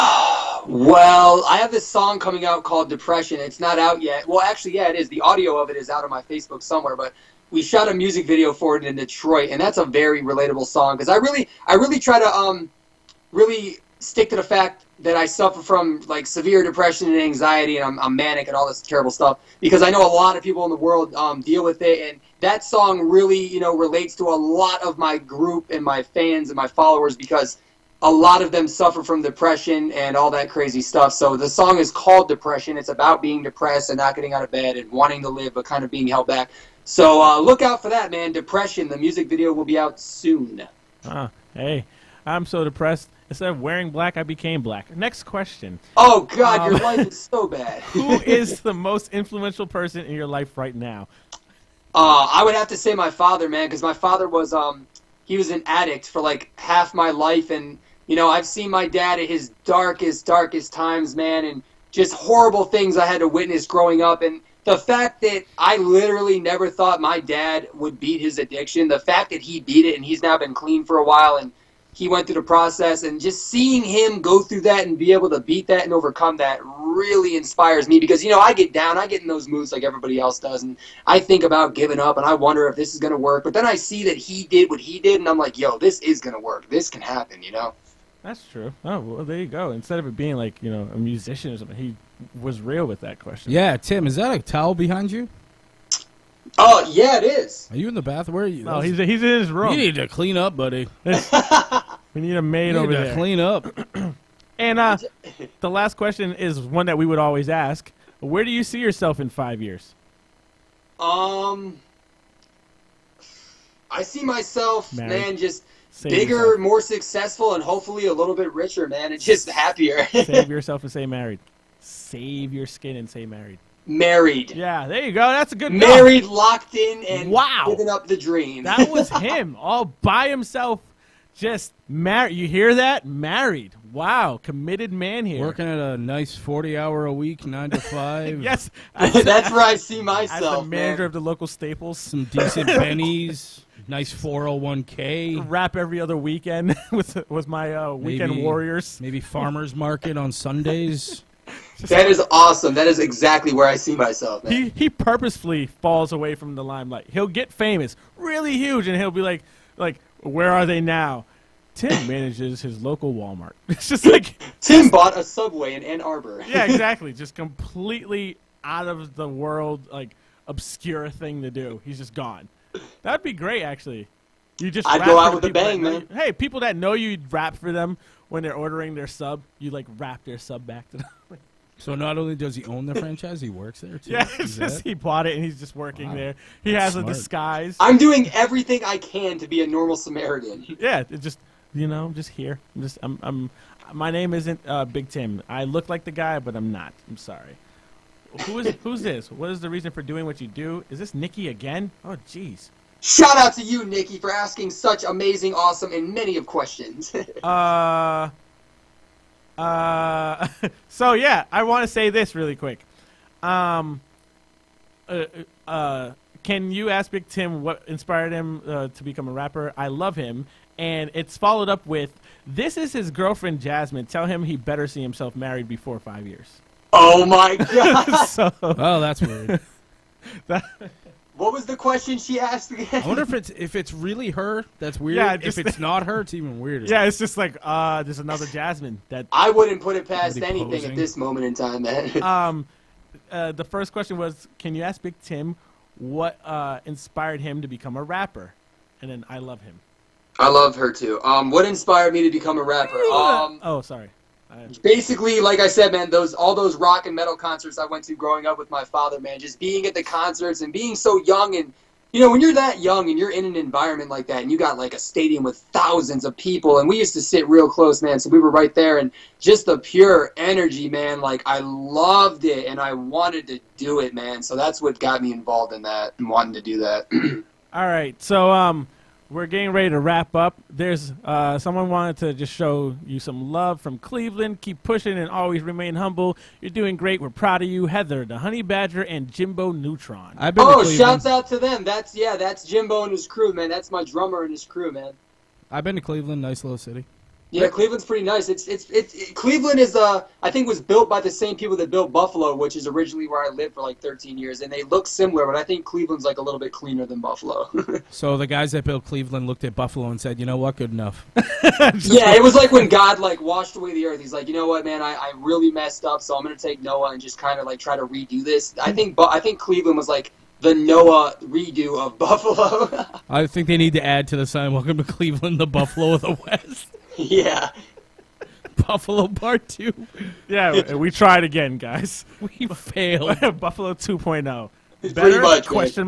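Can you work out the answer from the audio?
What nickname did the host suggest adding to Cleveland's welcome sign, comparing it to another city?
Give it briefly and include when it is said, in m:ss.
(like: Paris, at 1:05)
The Buffalo of the West, at 5:25.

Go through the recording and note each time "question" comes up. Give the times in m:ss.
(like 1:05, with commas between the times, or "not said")
0:45, 1:33, 1:45, 3:26, 3:51, 4:03.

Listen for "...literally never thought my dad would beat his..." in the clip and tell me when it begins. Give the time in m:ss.
1:05.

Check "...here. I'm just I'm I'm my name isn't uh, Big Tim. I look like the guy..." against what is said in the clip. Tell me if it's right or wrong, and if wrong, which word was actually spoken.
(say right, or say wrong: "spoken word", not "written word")
right.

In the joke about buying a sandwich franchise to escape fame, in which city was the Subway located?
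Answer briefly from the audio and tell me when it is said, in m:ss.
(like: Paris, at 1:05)
Ann Arbor, at 2:45.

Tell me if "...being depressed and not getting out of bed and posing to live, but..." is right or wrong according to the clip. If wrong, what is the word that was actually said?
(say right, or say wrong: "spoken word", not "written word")
wrong: "wanting", not "posing".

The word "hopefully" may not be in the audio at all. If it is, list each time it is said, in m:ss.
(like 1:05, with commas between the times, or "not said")
1:57.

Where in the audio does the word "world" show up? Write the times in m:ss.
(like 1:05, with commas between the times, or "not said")
0:20, 2:49.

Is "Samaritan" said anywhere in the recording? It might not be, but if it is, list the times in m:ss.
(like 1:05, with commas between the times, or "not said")
3:09.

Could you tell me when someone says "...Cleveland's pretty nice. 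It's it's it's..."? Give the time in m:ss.
4:57.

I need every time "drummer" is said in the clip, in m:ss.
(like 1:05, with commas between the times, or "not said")
4:54.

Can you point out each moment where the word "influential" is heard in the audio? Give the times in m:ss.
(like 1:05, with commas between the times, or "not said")
0:49.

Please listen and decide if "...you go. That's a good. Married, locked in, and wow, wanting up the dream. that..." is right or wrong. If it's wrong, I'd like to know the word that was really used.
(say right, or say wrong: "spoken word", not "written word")
wrong: "living", not "wanting".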